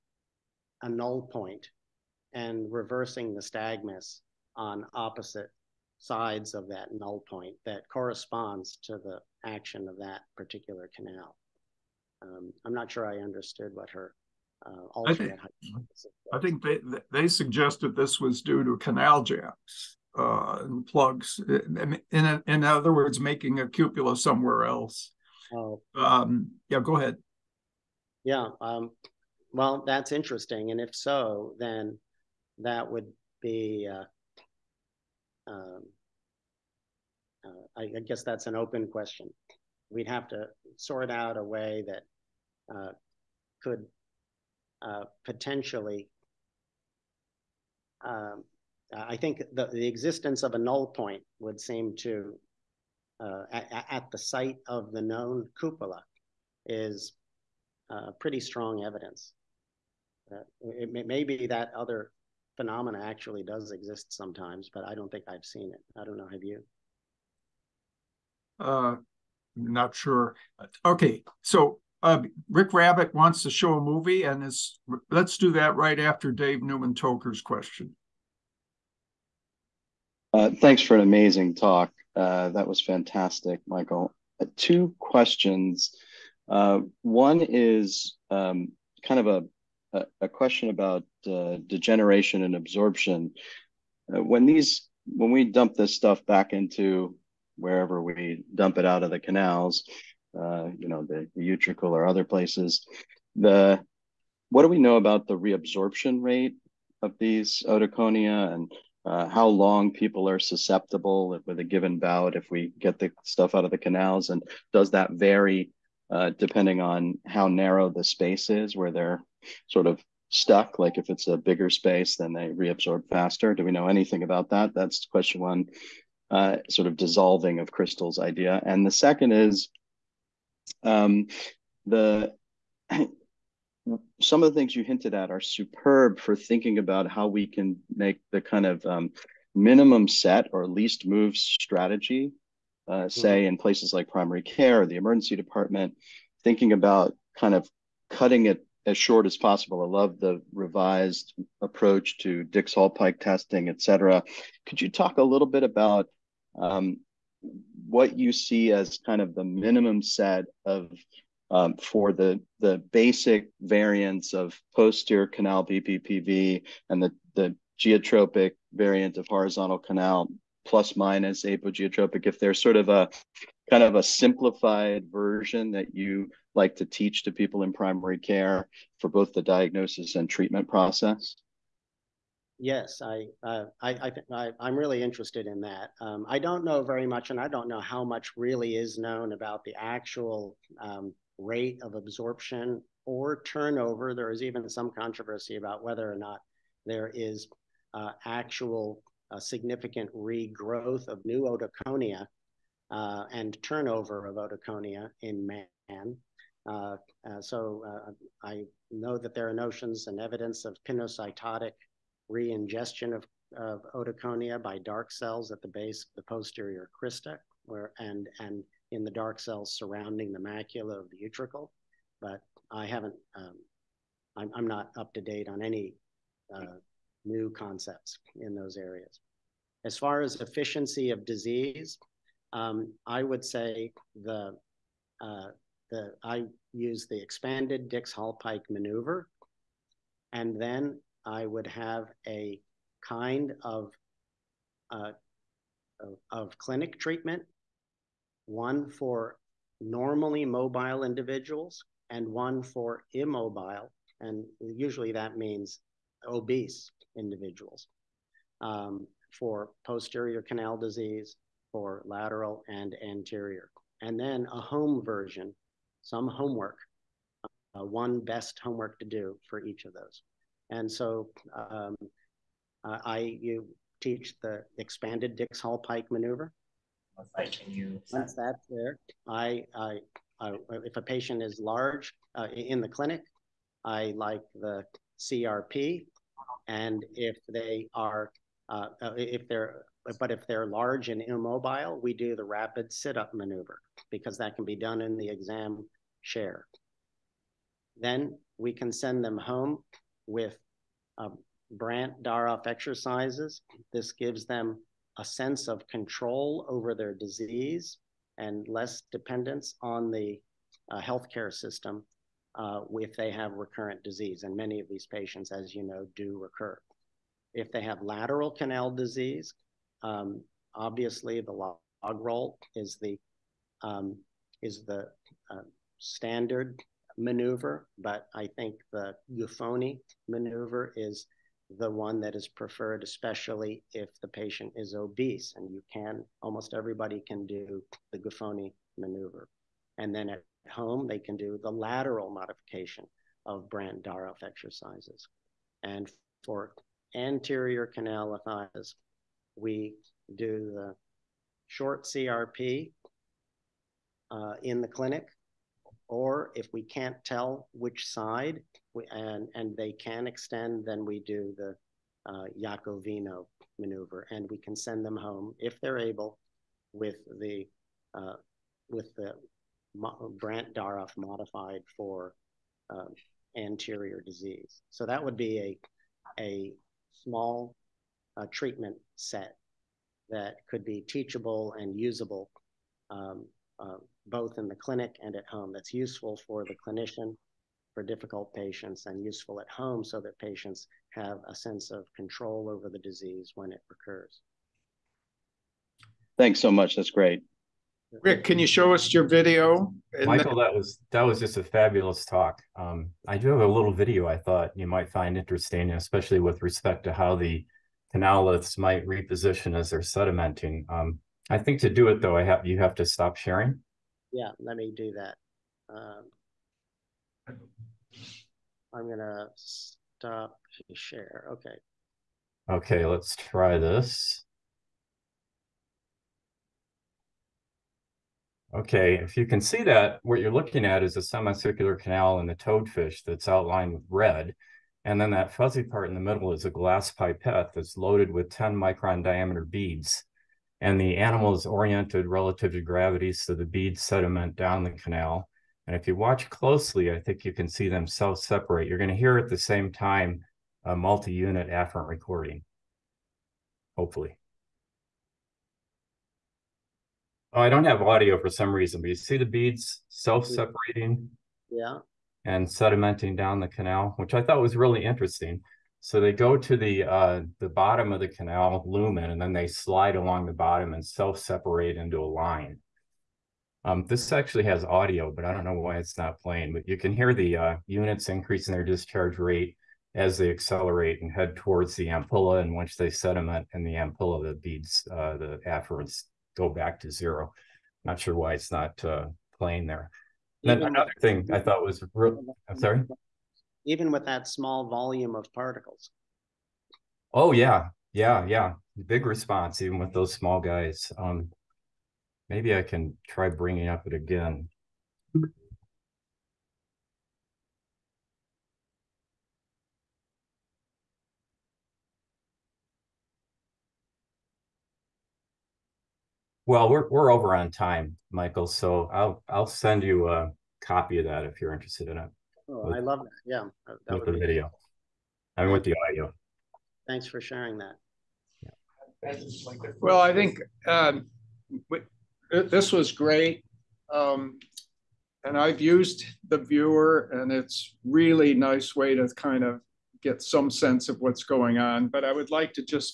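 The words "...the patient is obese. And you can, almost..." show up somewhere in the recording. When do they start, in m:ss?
5:34.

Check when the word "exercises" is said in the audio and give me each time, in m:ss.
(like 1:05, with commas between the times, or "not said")
5:02, 5:44.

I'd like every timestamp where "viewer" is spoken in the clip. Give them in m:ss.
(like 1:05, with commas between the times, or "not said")
8:56.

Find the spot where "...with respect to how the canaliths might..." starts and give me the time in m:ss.
6:46.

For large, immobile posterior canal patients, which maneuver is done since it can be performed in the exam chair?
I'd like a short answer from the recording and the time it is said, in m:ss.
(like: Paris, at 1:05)
Rapid sit-up maneuver, at 4:52.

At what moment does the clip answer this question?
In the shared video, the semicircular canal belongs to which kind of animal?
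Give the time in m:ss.
7:12.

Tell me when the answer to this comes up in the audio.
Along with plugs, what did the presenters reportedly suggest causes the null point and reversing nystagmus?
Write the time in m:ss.
0:18.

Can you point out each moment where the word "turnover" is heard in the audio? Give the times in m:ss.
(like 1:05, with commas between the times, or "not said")
3:13, 3:23.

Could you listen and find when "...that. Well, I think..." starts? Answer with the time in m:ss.
8:47.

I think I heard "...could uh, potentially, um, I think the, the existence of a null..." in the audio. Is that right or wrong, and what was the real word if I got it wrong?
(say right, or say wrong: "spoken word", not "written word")
right.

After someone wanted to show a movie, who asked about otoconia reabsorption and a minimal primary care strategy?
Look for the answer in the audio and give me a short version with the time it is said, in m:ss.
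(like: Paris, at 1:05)
Dave Newman-Toker, at 1:16.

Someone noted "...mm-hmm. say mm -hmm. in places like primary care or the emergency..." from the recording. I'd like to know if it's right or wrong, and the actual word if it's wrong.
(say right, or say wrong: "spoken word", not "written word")
right.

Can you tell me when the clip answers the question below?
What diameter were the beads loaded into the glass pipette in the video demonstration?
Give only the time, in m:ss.
7:18.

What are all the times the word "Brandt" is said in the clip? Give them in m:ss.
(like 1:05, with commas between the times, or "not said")
5:01, 5:43, 6:10.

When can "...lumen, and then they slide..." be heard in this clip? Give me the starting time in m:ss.
7:48.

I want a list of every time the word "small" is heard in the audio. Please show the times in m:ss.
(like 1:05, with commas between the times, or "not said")
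6:17, 8:14, 8:20.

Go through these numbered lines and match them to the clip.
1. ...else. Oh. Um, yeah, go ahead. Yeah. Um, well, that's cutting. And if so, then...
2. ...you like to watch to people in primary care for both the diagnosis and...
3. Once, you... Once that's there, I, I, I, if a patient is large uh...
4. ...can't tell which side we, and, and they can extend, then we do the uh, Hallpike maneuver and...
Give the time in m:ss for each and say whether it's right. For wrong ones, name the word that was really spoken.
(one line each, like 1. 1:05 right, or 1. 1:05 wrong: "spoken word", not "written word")
1. 0:24 wrong: "interesting", not "cutting"
2. 2:55 wrong: "teach", not "watch"
3. 4:37 right
4. 5:56 wrong: "Yacovino", not "Hallpike".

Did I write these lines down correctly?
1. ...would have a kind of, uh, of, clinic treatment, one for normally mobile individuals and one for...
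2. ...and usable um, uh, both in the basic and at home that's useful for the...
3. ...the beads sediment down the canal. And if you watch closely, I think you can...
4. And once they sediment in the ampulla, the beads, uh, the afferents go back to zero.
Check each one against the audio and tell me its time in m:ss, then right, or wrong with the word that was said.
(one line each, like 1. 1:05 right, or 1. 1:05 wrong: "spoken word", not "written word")
1. 4:01 right
2. 6:21 wrong: "clinic", not "basic"
3. 7:23 right
4. 8:02 right.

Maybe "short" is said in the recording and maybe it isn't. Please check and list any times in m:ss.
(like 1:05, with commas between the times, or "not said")
2:28, 5:51.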